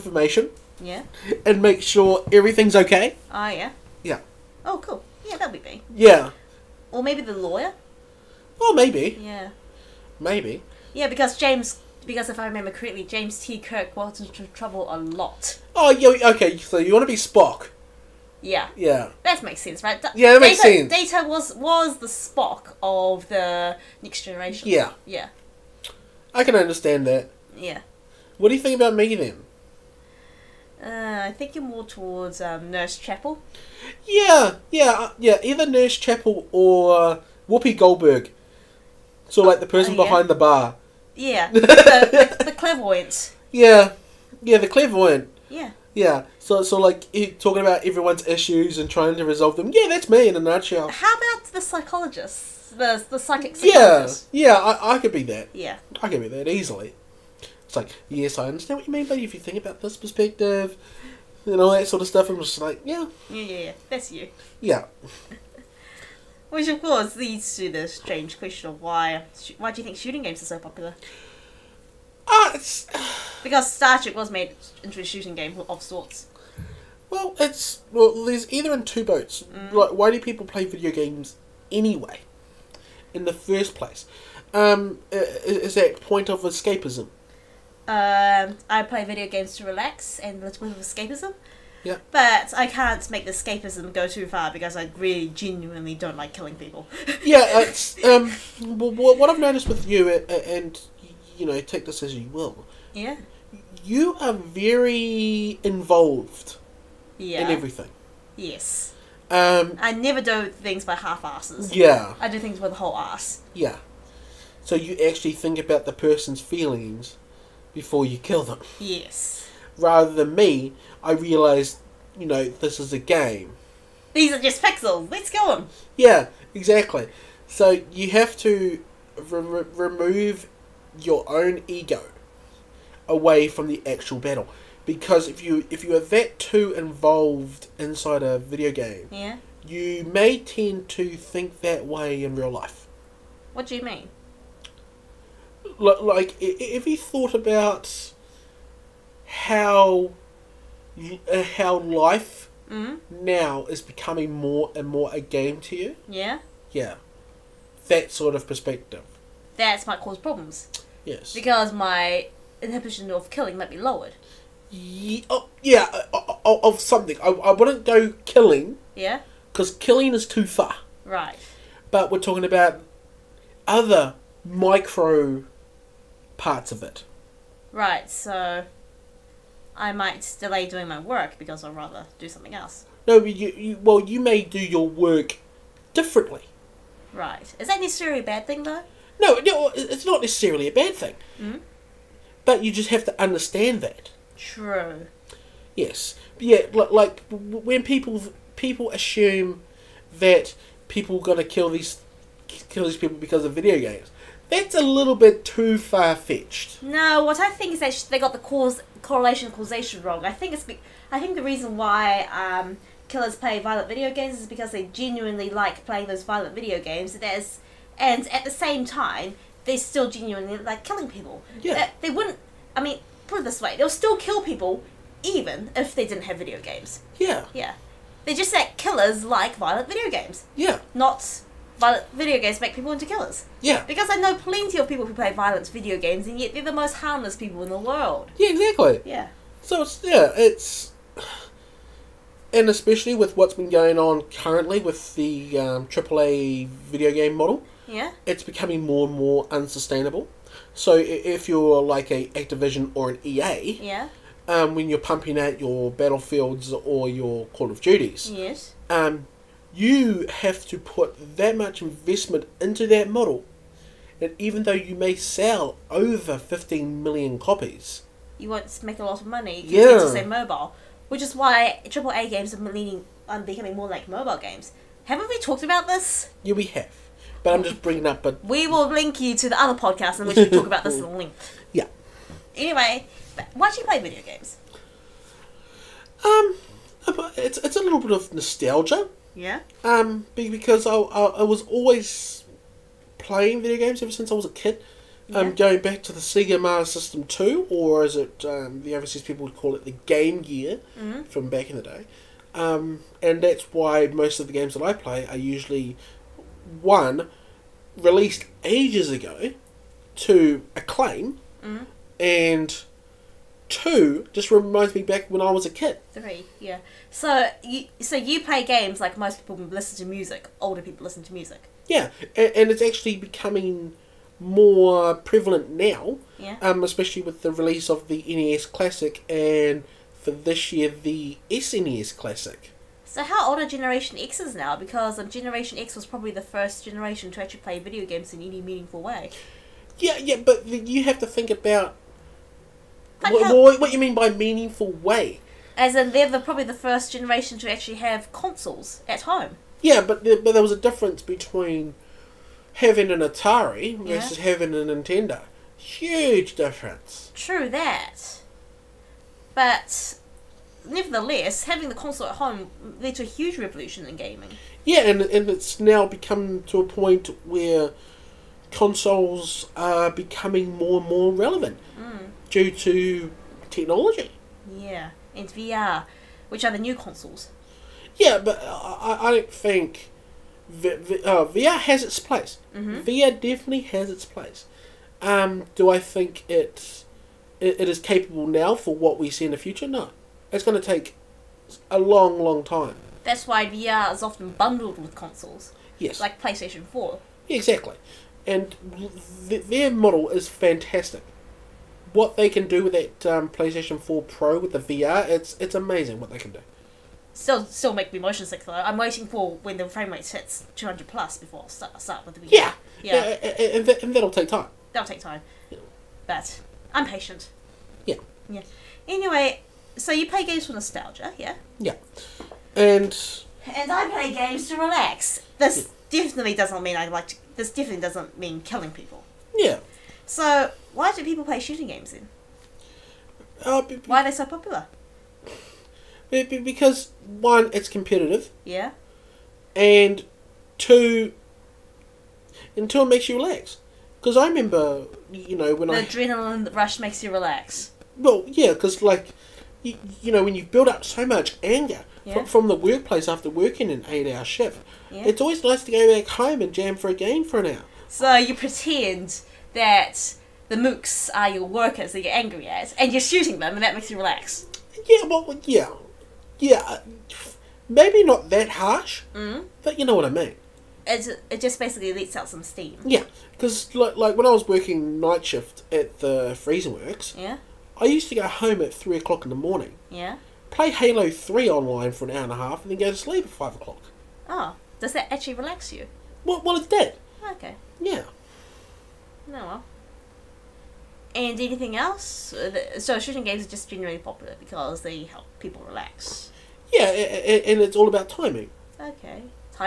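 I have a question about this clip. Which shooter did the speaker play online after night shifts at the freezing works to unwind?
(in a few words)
Halo Three.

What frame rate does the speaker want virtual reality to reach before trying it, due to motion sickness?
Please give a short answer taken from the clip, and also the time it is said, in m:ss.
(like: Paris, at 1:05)
200 plus, at 6:50.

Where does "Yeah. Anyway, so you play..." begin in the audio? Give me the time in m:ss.
6:58.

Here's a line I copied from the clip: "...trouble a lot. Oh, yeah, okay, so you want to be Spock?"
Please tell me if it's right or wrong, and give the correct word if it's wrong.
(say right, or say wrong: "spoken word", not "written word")
right.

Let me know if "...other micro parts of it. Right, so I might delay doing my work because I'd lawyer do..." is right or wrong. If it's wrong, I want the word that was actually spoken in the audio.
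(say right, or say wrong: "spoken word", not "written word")
wrong: "rather", not "lawyer".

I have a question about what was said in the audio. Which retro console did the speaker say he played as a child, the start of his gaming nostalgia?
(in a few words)
Sega Master System Two.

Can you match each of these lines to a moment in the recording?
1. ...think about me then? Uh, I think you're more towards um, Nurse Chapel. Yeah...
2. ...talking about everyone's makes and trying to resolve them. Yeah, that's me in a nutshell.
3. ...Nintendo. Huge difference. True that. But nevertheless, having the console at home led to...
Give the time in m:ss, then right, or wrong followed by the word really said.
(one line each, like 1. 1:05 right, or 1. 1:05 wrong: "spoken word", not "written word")
1. 0:28 right
2. 0:47 wrong: "issues", not "makes"
3. 5:54 right.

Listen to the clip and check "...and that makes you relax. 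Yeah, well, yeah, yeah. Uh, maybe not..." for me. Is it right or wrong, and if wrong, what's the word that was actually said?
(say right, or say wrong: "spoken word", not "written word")
right.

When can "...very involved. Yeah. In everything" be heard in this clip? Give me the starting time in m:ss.
1:44.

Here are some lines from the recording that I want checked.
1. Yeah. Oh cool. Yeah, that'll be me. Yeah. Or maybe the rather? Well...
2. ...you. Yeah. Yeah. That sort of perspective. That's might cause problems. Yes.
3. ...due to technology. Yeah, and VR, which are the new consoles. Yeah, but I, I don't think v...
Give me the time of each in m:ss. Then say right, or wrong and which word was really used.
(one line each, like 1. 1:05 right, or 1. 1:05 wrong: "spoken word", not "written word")
1. 0:04 wrong: "lawyer", not "rather"
2. 2:35 right
3. 6:12 right.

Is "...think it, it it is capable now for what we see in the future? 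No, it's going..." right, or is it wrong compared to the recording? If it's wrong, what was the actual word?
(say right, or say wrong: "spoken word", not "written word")
right.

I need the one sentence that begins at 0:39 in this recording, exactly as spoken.
So like the person oh, yeah.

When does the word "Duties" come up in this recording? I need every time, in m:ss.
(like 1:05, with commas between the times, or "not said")
4:17.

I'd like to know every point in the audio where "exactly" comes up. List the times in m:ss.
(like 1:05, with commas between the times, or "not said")
2:06, 3:58, 6:37.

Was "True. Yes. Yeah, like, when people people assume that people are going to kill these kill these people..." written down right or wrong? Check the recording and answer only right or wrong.
right.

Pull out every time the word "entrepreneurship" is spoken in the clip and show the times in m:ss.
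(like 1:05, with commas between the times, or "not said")
not said.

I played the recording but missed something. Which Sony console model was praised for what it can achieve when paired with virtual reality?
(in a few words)
PlayStation Four Pro.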